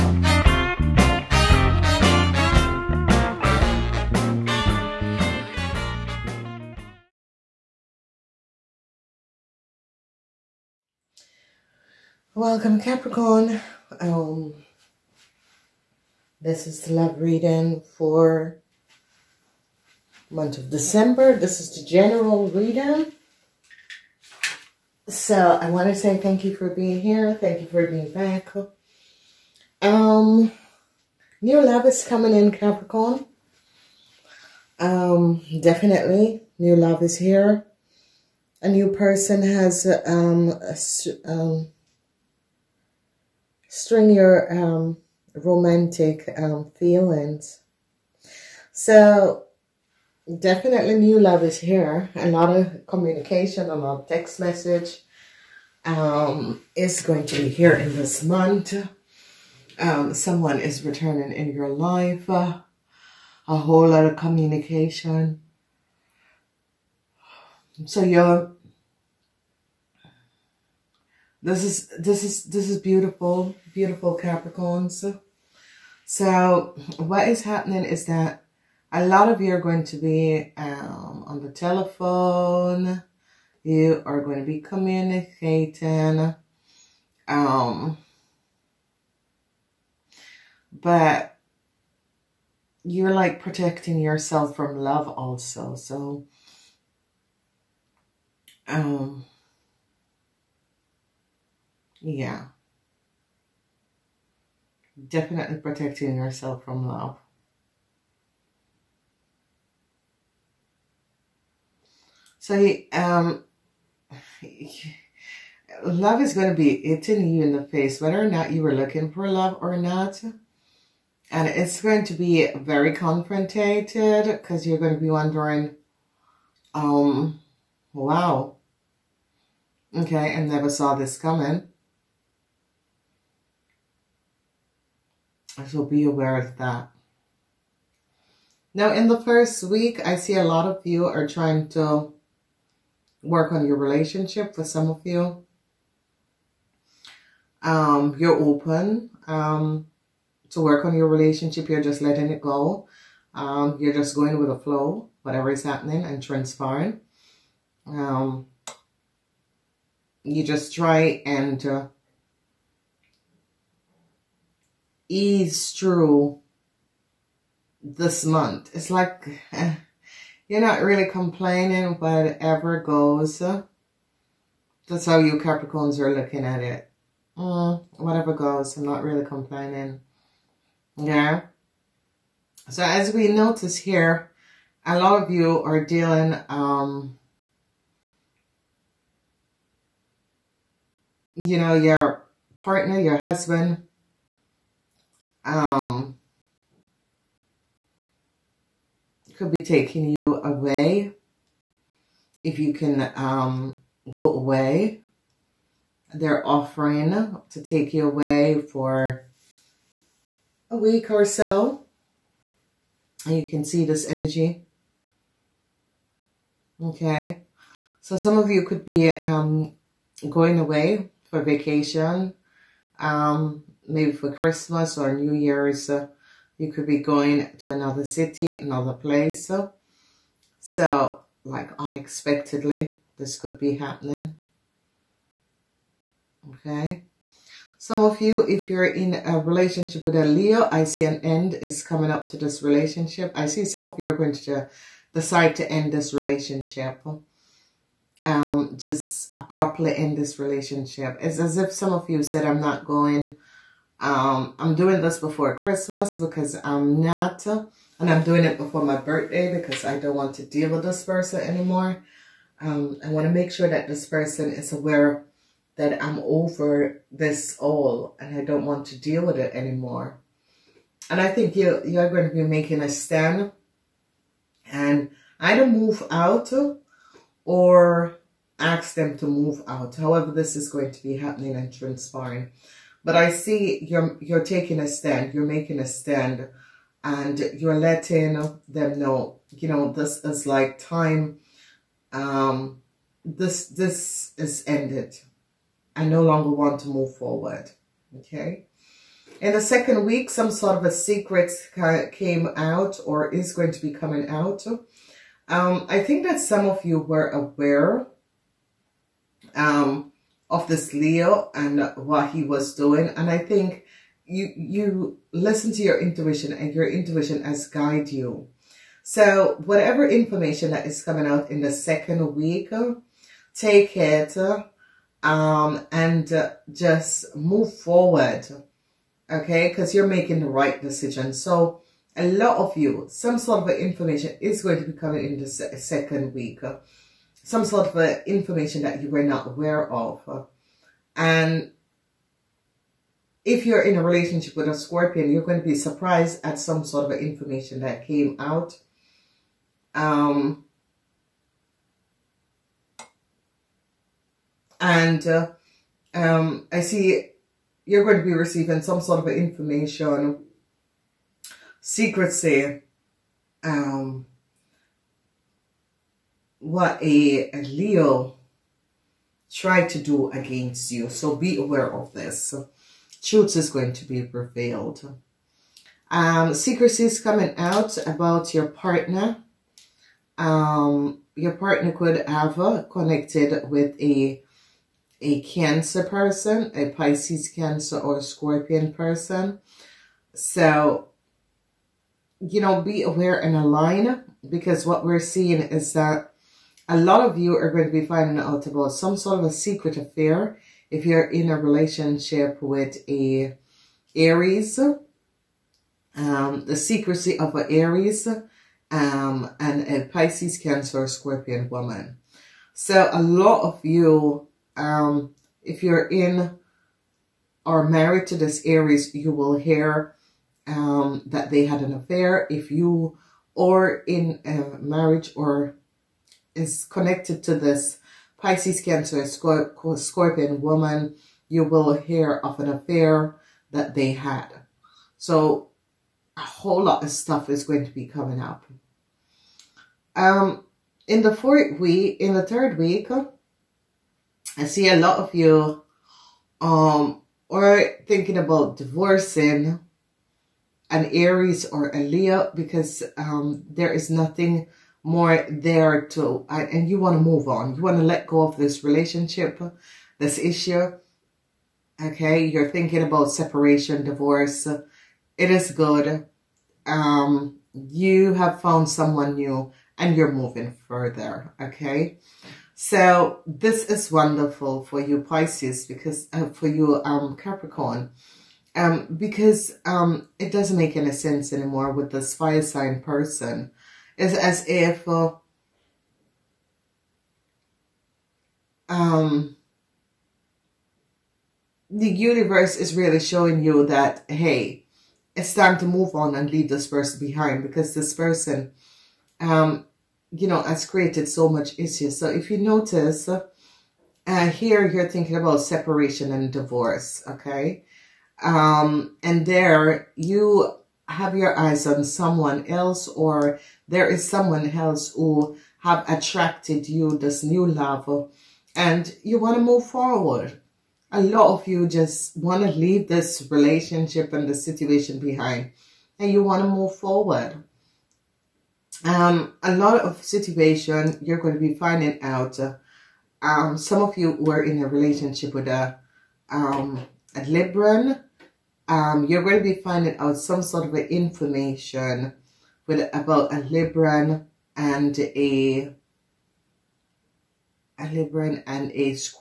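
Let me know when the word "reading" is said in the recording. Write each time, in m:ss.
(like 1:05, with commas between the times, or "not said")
0:17, 0:22.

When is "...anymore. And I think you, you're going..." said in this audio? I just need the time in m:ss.
4:29.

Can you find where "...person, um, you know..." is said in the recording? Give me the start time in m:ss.
8:18.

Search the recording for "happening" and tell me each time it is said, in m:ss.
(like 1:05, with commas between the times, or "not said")
1:17, 2:35, 3:53, 4:41.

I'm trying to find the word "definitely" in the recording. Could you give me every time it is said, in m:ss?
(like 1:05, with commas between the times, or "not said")
0:35, 0:50, 1:45.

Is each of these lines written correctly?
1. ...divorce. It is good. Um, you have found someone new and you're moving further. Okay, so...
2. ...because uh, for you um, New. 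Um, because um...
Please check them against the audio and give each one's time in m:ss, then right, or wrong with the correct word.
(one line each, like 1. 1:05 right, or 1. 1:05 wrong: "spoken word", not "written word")
1. 7:44 right
2. 7:55 wrong: "Capricorn", not "New".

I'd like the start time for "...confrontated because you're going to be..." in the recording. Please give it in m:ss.
2:02.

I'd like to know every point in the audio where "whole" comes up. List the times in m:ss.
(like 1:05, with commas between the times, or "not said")
1:03, 7:16.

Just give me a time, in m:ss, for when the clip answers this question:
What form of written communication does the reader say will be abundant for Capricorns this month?
0:54.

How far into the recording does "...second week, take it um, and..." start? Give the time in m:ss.
5:21.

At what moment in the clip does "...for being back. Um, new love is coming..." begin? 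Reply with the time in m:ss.
0:27.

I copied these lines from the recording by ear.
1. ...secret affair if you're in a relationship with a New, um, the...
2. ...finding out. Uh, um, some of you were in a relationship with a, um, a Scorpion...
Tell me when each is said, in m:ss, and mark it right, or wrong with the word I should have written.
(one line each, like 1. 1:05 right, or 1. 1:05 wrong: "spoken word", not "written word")
1. 6:39 wrong: "Aries", not "New"
2. 8:51 wrong: "Libran", not "Scorpion".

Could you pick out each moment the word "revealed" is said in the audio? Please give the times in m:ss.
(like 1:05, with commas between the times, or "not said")
6:14.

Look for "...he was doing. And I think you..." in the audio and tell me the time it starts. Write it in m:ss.
5:12.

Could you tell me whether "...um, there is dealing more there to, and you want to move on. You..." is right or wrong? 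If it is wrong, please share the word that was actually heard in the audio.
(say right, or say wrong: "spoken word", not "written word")
wrong: "nothing", not "dealing".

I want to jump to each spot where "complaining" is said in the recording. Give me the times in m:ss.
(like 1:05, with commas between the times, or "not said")
2:51, 2:59.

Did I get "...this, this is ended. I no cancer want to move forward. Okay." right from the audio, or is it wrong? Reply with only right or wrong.
wrong.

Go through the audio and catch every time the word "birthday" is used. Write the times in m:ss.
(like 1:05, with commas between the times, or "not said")
4:18.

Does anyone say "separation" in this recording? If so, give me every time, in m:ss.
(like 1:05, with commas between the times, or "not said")
7:43, 8:25.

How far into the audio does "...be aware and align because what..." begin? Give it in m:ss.
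6:32.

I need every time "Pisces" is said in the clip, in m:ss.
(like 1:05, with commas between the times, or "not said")
6:26, 6:50, 7:08, 7:55.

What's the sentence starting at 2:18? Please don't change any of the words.
Now, in the first week, I see a lot of you are trying to work on your relationship for some of you.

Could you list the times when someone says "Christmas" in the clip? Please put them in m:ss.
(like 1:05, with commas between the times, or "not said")
3:44, 4:15.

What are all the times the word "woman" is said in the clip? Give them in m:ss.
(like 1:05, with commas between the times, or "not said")
6:51, 7:10.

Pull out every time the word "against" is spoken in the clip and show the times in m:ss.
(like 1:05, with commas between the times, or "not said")
6:10.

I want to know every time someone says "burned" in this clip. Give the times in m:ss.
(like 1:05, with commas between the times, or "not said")
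not said.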